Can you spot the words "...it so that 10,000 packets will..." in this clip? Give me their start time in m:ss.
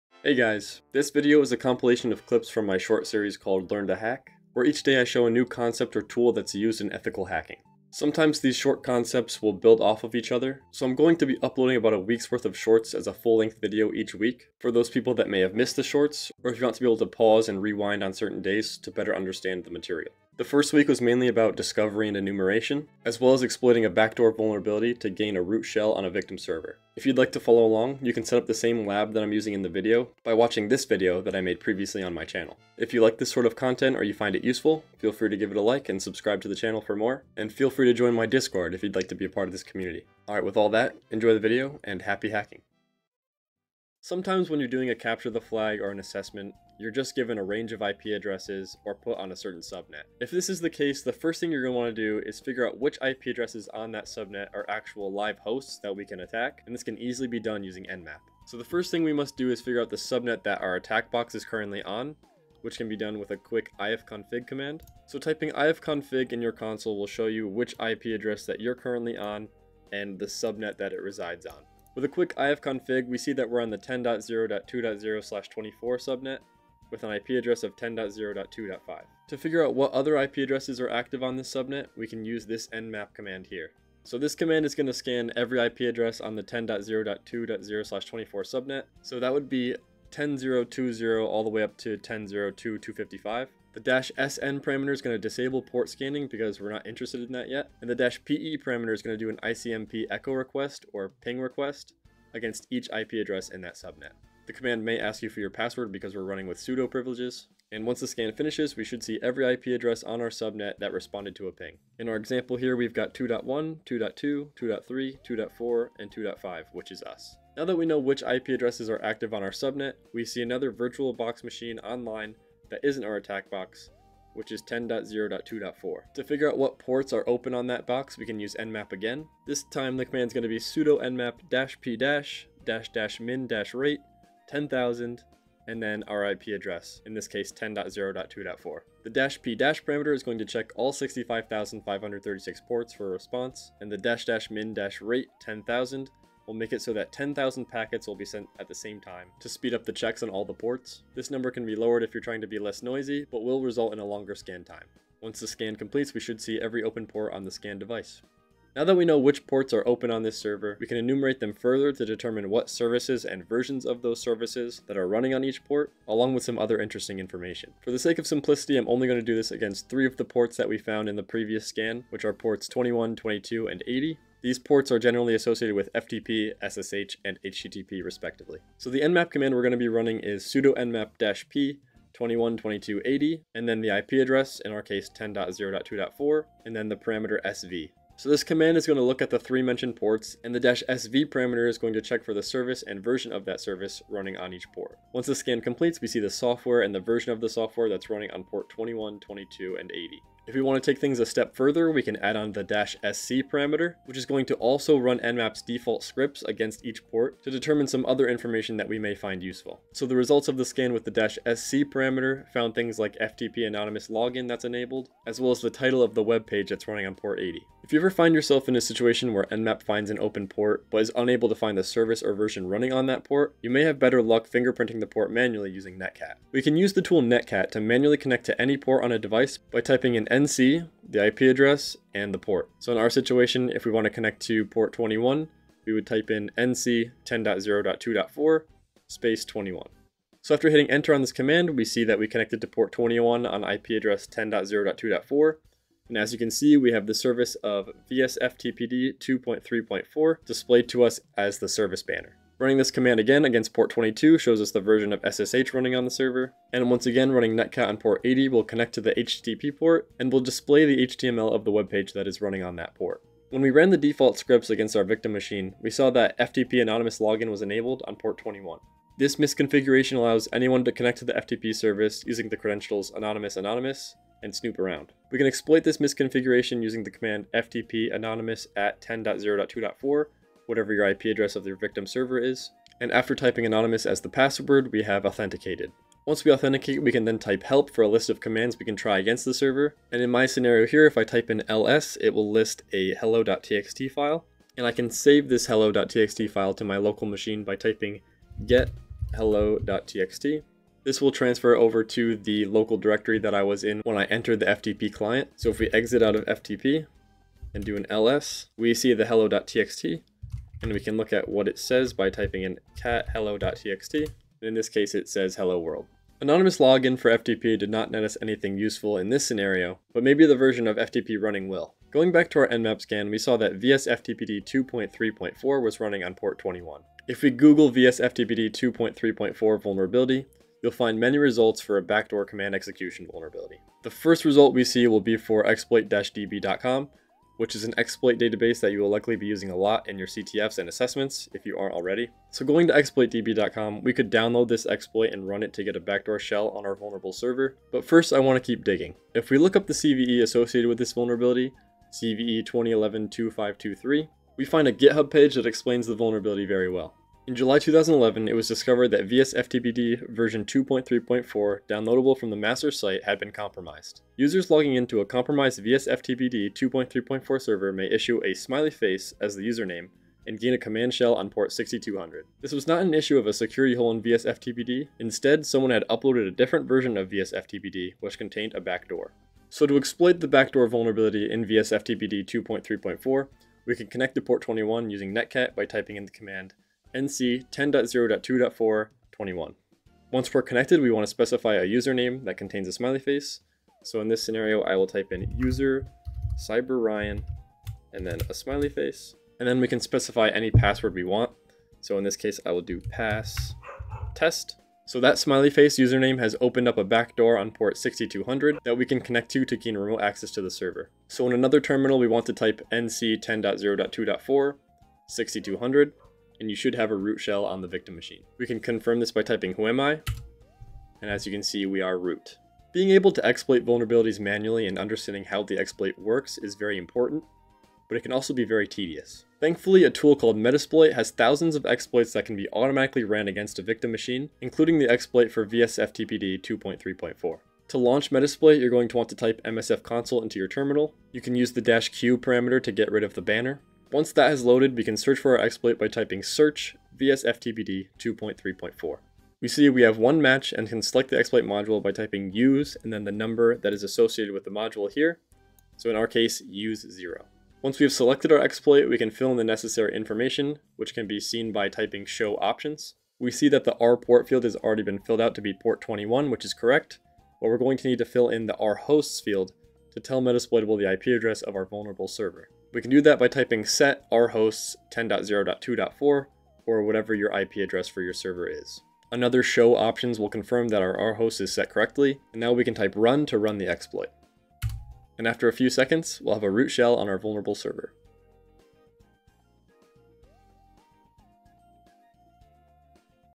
2:26.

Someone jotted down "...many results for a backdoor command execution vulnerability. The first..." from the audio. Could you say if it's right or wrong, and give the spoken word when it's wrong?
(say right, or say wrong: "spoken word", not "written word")
right.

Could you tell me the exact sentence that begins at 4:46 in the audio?
Once we authenticate, we can then type help for a list of commands we can try against the server.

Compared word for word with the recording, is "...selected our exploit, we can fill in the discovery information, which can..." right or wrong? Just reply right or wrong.
wrong.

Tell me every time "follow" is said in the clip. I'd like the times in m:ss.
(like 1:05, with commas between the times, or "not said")
0:27.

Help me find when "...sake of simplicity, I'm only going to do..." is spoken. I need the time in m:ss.
2:47.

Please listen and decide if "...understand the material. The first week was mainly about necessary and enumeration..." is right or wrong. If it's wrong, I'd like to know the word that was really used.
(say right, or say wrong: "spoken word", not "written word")
wrong: "discovery", not "necessary".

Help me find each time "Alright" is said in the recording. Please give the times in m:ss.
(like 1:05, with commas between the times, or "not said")
0:40.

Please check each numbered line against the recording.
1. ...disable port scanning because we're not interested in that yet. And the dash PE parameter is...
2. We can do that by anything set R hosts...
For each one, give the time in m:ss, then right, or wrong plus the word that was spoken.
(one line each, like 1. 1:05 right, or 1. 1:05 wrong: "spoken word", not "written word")
1. 1:35 right
2. 7:52 wrong: "typing", not "anything".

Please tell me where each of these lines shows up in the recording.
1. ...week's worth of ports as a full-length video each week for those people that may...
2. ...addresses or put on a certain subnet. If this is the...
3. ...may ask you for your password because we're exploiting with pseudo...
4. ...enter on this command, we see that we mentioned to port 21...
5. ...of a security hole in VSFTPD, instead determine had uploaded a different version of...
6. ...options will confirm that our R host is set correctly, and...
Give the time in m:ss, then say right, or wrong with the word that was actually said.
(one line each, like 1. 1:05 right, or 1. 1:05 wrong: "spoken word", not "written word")
1. 0:11 wrong: "shorts", not "ports"
2. 0:48 right
3. 1:44 wrong: "running", not "exploiting"
4. 4:00 wrong: "connected", not "mentioned"
5. 6:13 wrong: "someone", not "determine"
6. 7:59 right.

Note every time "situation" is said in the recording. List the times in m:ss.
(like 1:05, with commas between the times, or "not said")
3:38, 3:53.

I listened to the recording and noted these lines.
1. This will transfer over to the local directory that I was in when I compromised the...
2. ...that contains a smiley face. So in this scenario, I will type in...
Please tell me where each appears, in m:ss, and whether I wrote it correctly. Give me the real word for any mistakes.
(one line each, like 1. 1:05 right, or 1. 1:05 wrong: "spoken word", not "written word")
1. 5:01 wrong: "entered", not "compromised"
2. 6:32 right.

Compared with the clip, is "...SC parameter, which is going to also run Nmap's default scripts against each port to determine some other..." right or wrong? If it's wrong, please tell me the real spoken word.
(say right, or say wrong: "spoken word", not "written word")
right.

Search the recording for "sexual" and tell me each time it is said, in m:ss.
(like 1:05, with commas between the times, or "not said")
not said.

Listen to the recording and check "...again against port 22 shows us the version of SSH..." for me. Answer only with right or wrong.
right.